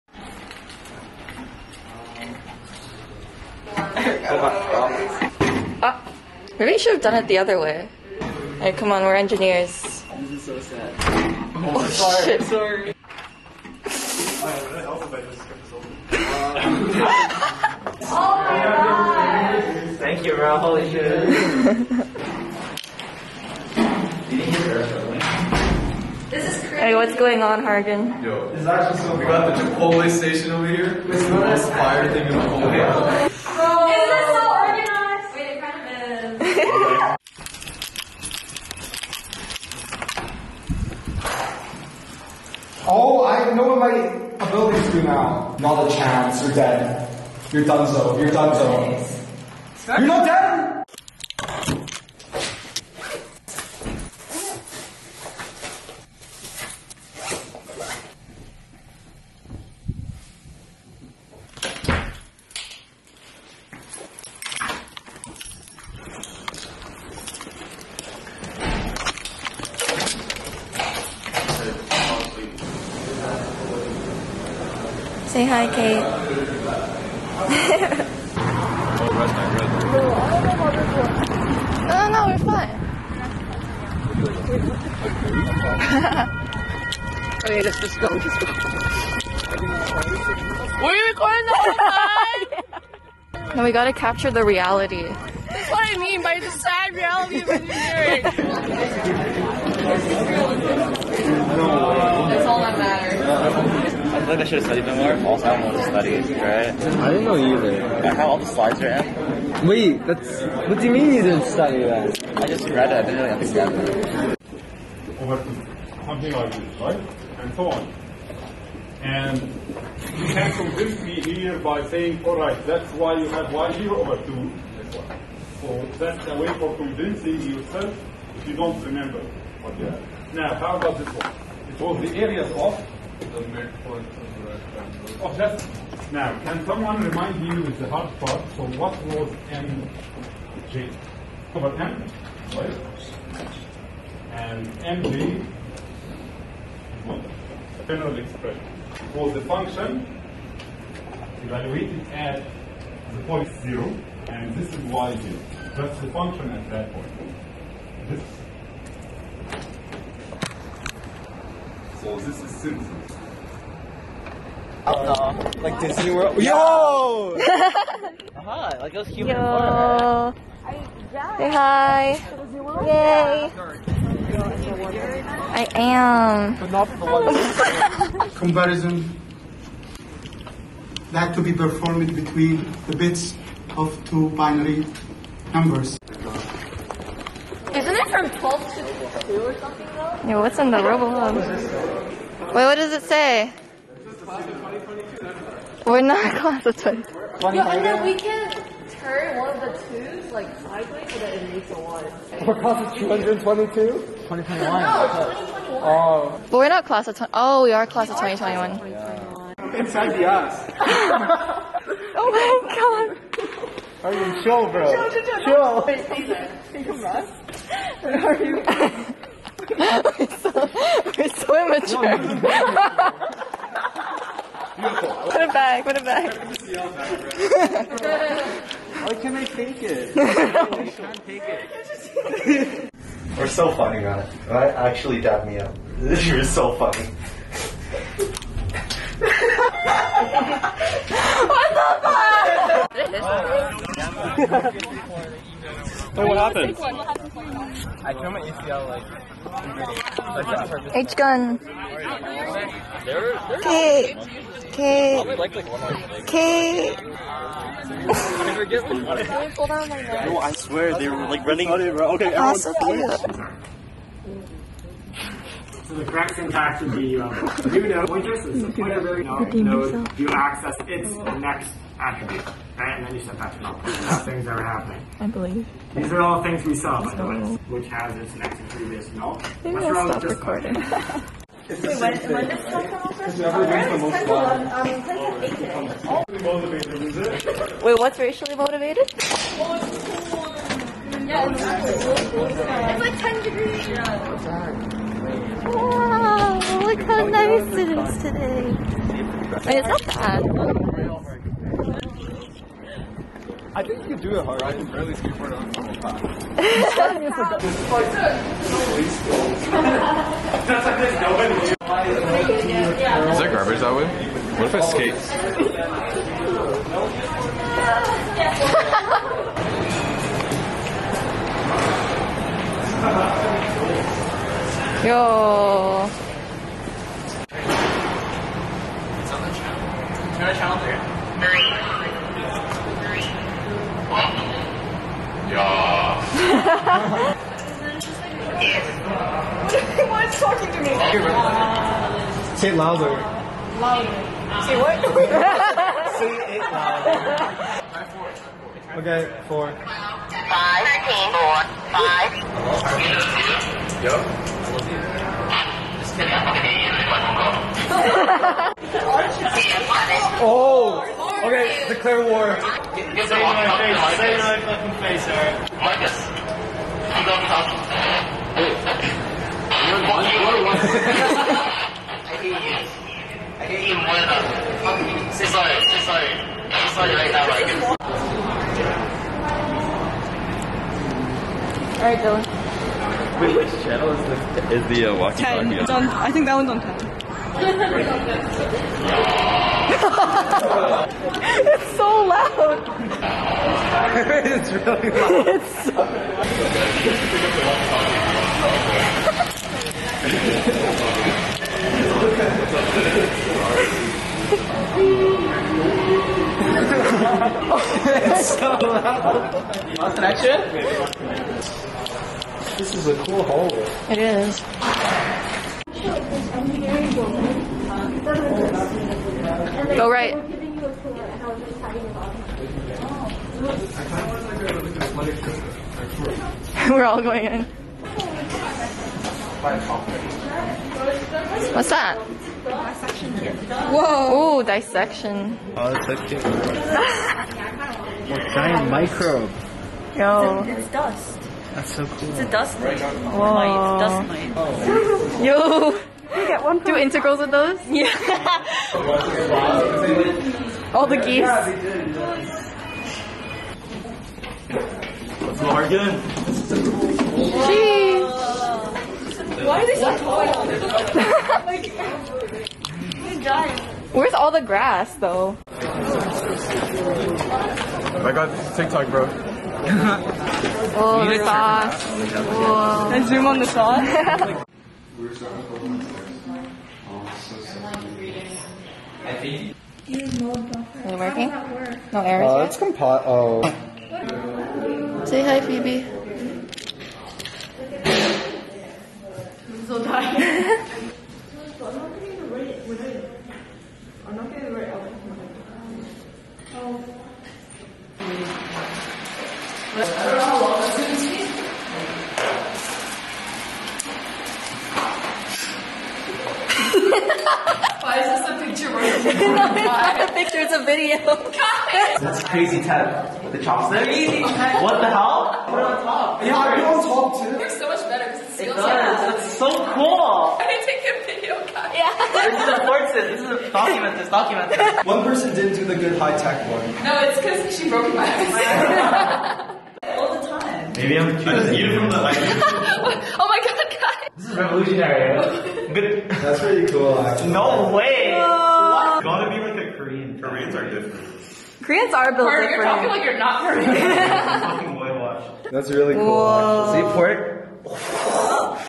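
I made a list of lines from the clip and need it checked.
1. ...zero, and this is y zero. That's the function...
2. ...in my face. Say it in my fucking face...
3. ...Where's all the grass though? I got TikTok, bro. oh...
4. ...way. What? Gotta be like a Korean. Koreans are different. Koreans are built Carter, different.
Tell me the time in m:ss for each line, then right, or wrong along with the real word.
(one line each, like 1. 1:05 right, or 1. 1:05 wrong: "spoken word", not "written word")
1. 2:33 right
2. 6:03 right
3. 7:44 right
4. 8:57 right.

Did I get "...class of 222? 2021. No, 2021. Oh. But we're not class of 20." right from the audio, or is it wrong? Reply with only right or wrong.
right.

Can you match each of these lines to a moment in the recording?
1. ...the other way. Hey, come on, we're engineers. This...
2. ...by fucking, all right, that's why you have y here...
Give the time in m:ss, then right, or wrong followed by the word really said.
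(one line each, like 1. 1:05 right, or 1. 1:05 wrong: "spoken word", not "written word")
1. 0:07 right
2. 2:01 wrong: "saying", not "fucking".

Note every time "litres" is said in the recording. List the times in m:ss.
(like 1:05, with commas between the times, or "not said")
not said.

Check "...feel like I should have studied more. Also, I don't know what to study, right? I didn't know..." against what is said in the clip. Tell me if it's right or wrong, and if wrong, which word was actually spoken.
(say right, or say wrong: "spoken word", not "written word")
right.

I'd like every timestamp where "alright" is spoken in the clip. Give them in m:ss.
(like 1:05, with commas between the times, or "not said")
6:05, 6:21.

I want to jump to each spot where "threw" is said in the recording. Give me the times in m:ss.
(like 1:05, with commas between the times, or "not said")
4:08.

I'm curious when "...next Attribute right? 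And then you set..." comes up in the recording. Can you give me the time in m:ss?
4:31.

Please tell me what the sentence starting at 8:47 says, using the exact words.
No, it's because she broke my eyes.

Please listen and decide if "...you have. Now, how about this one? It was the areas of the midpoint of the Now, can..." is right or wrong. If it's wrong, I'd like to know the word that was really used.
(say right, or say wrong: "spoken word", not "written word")
right.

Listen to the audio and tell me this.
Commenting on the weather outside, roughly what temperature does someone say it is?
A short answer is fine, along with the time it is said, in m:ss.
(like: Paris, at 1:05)
10 degrees, at 4:53.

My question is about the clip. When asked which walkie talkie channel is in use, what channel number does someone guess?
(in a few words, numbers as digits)
ten.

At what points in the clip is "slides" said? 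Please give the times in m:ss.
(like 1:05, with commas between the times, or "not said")
1:48.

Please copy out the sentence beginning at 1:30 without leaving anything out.
Were you recording the whole time?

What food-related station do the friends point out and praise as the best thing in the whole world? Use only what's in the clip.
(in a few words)
Chipotle station.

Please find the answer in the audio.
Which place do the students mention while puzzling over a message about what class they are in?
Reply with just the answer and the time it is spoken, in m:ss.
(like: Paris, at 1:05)
RoboHub, at 3:10.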